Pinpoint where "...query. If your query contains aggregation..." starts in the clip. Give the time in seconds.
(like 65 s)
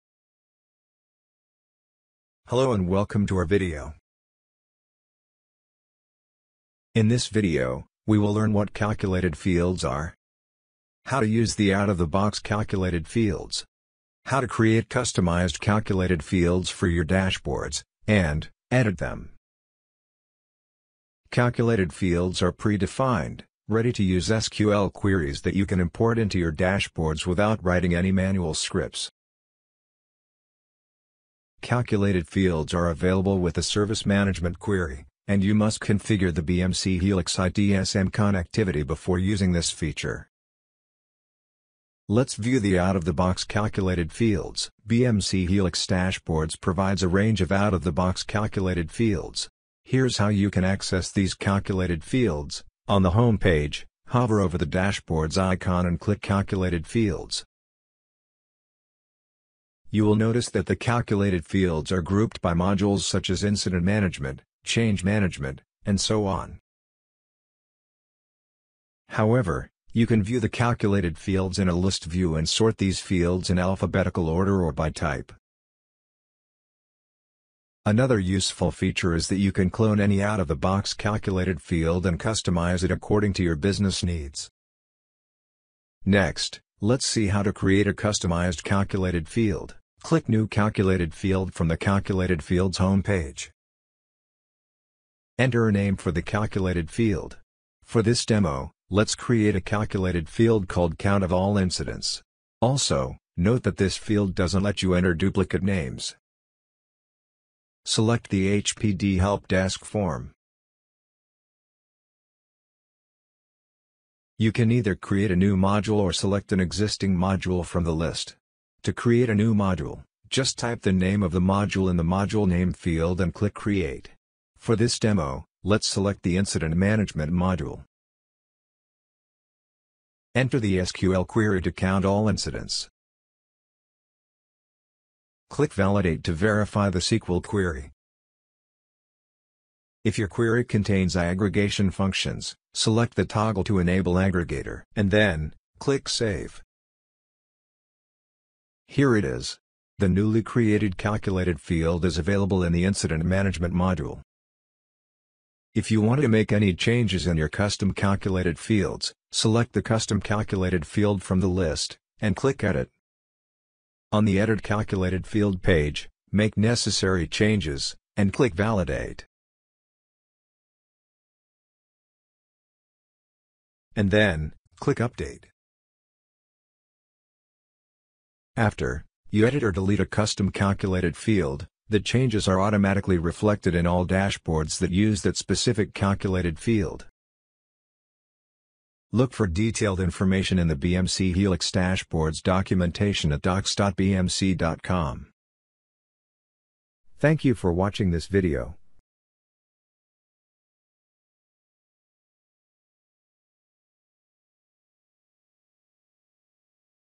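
137 s.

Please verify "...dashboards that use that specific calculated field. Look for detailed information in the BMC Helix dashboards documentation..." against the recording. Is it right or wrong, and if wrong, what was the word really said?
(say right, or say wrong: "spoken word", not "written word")
right.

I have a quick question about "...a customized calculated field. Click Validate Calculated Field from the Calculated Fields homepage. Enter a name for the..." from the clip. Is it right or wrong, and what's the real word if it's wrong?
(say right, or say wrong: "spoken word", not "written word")
wrong: "New", not "Validate".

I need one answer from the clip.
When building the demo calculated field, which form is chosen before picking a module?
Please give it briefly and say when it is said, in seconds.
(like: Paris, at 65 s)
HPD Help Desk, at 108 s.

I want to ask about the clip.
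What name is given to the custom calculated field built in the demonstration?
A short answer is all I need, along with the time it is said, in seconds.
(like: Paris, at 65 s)
Count of All Incidents, at 100 s.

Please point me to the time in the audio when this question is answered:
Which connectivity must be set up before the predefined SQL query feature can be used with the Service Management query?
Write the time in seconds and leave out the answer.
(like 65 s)
36 s.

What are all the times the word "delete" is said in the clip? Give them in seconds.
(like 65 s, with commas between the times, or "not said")
179 s.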